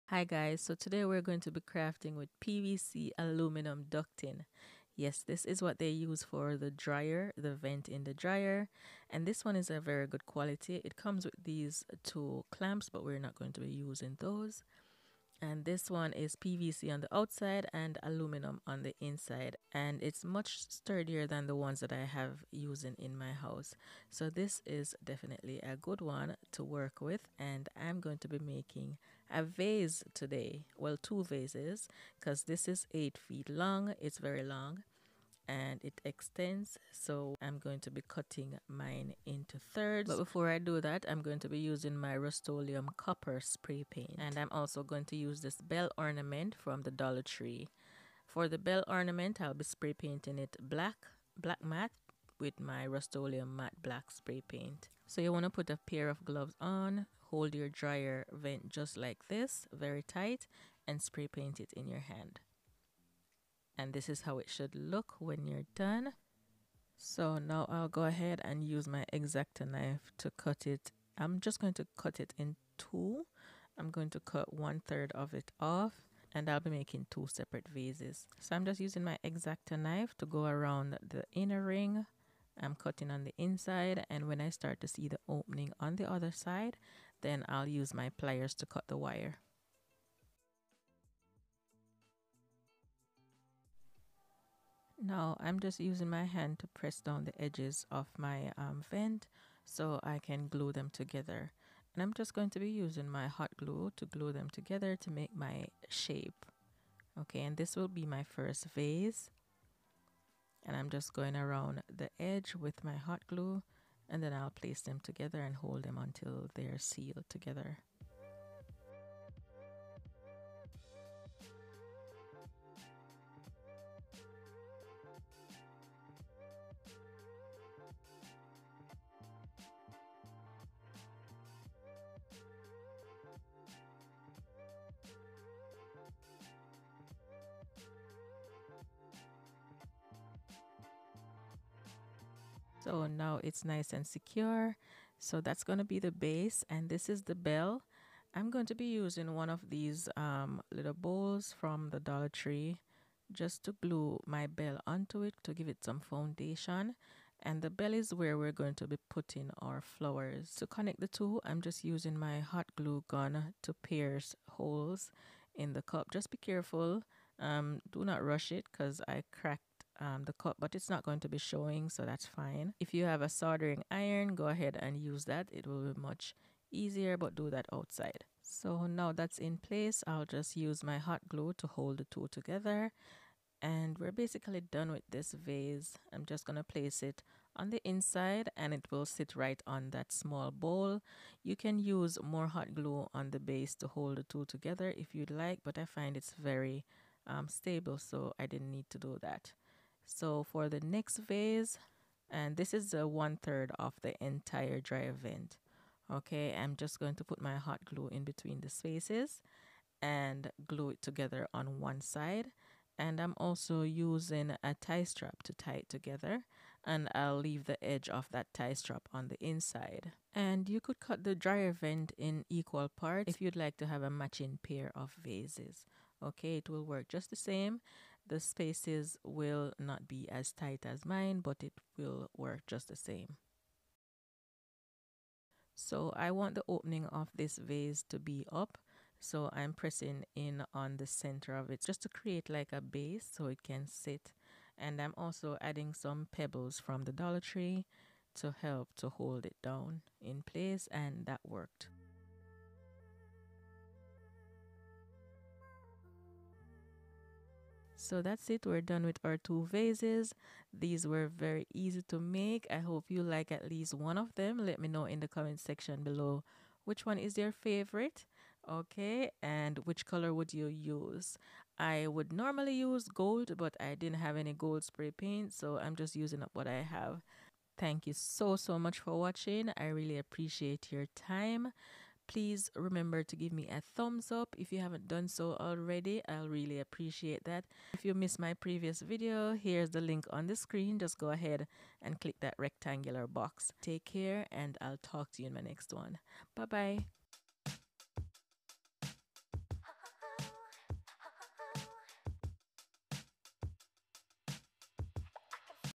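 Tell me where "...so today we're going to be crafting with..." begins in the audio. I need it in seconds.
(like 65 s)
0 s.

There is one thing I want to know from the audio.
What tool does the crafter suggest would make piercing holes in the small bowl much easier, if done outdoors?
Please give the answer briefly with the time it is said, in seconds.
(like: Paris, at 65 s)
Soldering iron, at 173 s.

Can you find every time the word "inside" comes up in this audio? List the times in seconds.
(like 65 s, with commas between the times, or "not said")
19 s, 83 s, 187 s, 219 s.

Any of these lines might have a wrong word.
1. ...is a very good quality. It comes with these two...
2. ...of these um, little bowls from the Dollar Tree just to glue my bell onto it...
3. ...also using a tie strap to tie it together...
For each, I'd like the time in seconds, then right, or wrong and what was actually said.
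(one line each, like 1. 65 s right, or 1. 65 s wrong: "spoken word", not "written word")
1. 9 s right
2. 149 s right
3. 213 s right.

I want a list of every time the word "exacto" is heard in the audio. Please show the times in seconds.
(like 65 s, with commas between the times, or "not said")
69 s, 79 s.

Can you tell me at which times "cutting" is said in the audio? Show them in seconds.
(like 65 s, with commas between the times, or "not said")
38 s, 82 s.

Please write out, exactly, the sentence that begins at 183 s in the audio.
And we're basically done with this vase.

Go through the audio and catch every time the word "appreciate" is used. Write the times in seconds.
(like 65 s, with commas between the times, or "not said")
280 s, 286 s.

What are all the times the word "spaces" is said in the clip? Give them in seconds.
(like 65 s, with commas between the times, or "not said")
208 s, 228 s.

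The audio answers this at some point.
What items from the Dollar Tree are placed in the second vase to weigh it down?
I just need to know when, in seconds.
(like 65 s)
246 s.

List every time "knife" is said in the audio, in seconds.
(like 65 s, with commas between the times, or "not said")
69 s, 79 s.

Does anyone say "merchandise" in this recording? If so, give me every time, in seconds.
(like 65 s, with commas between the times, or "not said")
not said.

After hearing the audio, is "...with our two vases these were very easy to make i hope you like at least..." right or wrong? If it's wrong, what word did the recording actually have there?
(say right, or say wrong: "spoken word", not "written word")
right.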